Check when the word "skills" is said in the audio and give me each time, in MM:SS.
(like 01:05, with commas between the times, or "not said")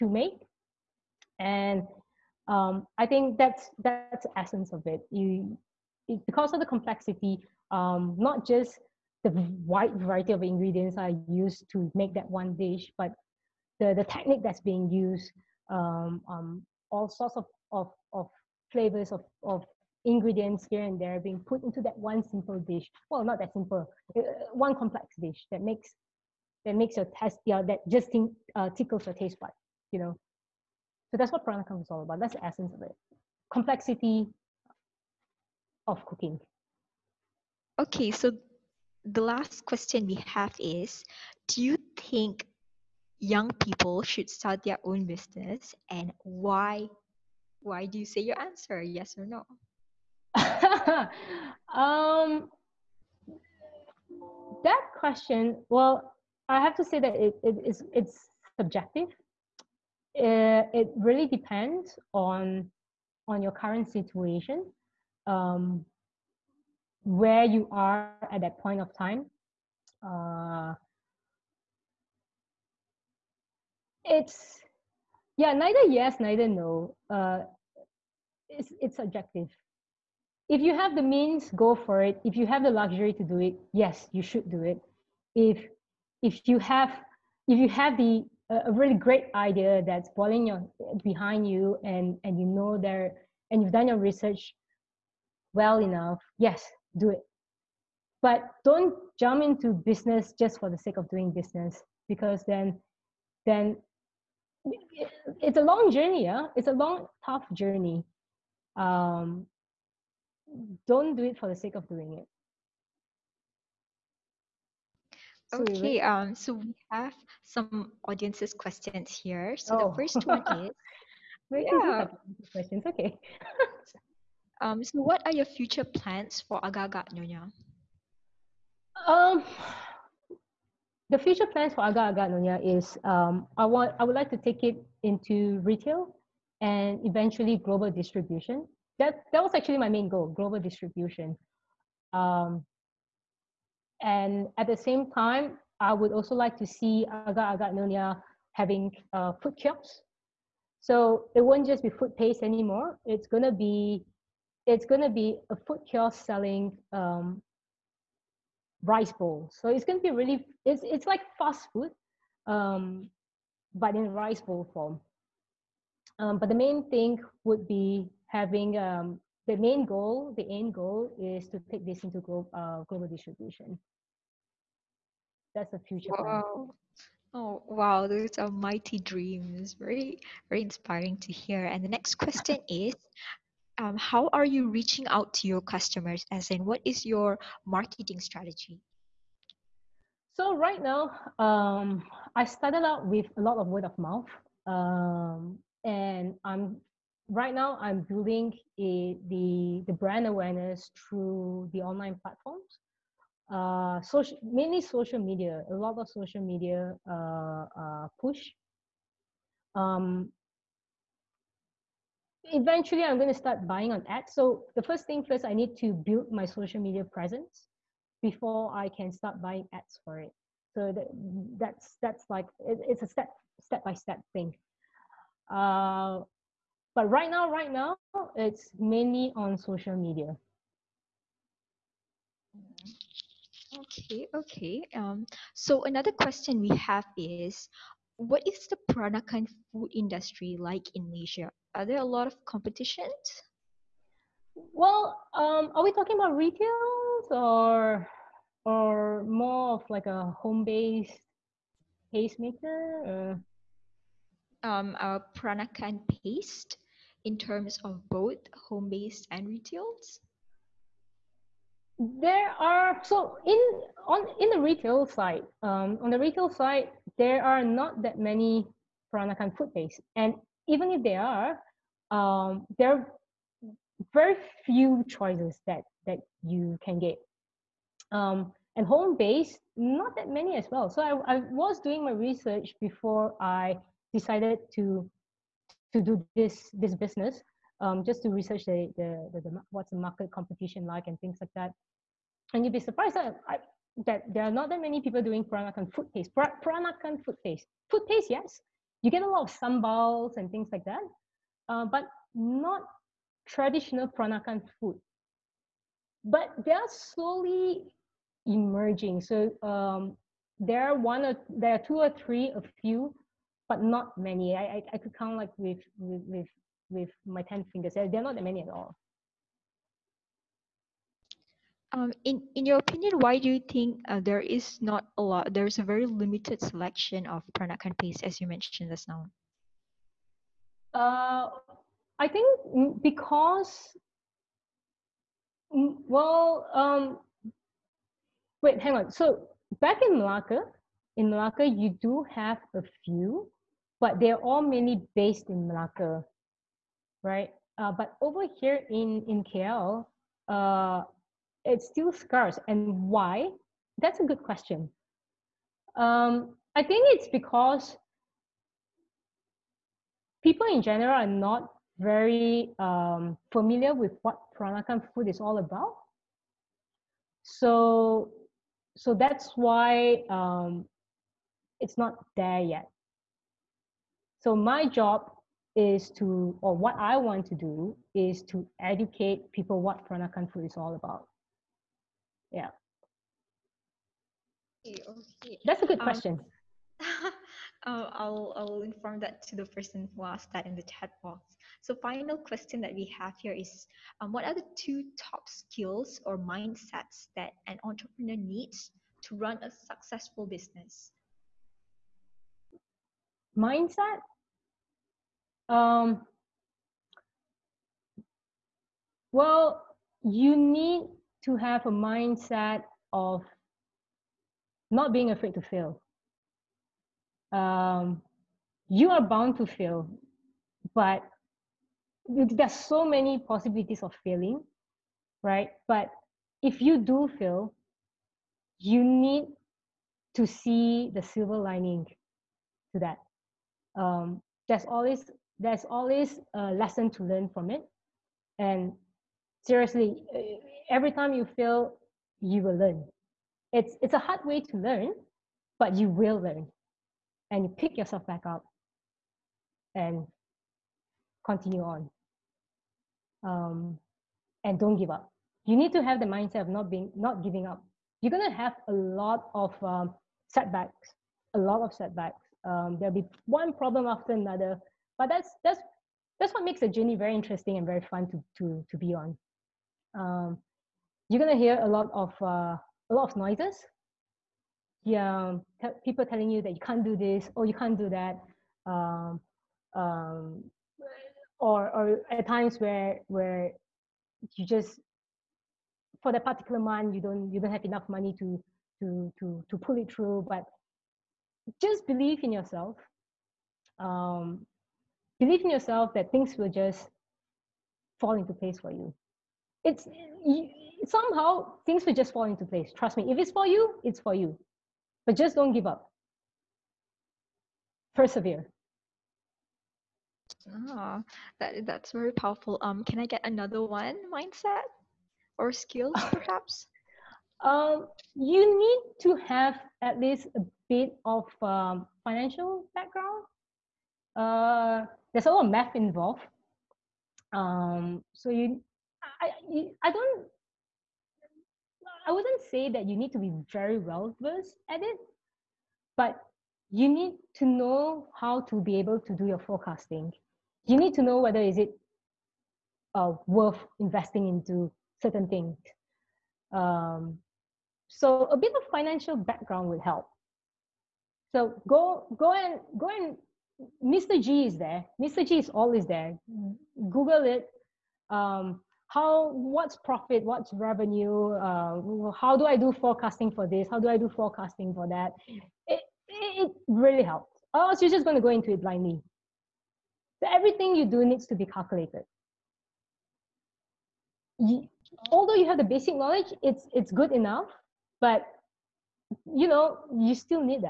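06:35, 08:35.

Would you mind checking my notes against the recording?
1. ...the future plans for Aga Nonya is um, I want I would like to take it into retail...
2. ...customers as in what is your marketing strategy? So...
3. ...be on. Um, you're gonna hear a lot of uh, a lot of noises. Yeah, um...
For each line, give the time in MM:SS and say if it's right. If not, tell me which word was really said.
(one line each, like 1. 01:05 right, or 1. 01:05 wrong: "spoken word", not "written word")
1. 02:11 right
2. 03:05 right
3. 07:48 right.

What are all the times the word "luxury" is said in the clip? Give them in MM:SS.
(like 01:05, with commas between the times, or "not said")
01:22.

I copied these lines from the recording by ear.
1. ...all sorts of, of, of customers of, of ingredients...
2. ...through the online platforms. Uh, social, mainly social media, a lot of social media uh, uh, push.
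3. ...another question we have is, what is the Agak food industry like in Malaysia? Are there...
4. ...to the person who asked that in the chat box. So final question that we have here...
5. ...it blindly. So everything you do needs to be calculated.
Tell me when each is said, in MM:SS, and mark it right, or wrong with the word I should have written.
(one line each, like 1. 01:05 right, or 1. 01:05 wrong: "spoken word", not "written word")
1. 00:16 wrong: "flavors", not "customers"
2. 03:20 right
3. 03:55 wrong: "Peranakan", not "Agak"
4. 06:29 right
5. 09:28 right.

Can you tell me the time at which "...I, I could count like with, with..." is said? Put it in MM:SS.
05:14.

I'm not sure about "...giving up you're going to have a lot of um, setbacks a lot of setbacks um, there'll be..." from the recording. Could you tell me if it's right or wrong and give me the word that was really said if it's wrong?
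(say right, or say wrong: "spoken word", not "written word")
right.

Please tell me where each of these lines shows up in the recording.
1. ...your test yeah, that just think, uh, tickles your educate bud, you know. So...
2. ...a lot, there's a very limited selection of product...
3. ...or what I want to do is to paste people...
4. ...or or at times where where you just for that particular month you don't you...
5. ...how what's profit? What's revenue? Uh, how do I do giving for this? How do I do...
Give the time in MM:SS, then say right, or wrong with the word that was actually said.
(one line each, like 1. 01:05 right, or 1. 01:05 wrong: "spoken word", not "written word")
1. 00:26 wrong: "taste", not "educate"
2. 05:25 right
3. 06:16 wrong: "educate", not "paste"
4. 08:01 right
5. 09:19 wrong: "forecasting", not "giving".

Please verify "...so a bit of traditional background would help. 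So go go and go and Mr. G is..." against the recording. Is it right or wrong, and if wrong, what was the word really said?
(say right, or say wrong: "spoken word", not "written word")
wrong: "financial", not "traditional".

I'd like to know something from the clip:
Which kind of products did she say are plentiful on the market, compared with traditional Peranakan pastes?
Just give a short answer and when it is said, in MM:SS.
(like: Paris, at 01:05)
Sambals, at 04:59.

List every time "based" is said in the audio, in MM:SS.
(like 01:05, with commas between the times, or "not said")
04:10, 04:18, 04:29, 04:39, 05:45.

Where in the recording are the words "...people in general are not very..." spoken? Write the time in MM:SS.
06:00.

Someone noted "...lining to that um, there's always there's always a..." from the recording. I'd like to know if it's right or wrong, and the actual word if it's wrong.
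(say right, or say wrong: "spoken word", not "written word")
right.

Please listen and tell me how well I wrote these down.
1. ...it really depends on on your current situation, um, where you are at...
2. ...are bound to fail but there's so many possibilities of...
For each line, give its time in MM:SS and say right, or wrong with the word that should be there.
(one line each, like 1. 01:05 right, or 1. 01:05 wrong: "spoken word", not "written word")
1. 01:00 right
2. 06:59 right.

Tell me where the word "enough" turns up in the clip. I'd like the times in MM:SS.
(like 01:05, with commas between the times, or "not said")
01:35, 08:07, 09:37.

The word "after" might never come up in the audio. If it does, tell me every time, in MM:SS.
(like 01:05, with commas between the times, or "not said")
07:44.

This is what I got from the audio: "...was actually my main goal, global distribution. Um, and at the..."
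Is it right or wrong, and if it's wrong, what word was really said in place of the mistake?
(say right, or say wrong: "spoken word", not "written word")
right.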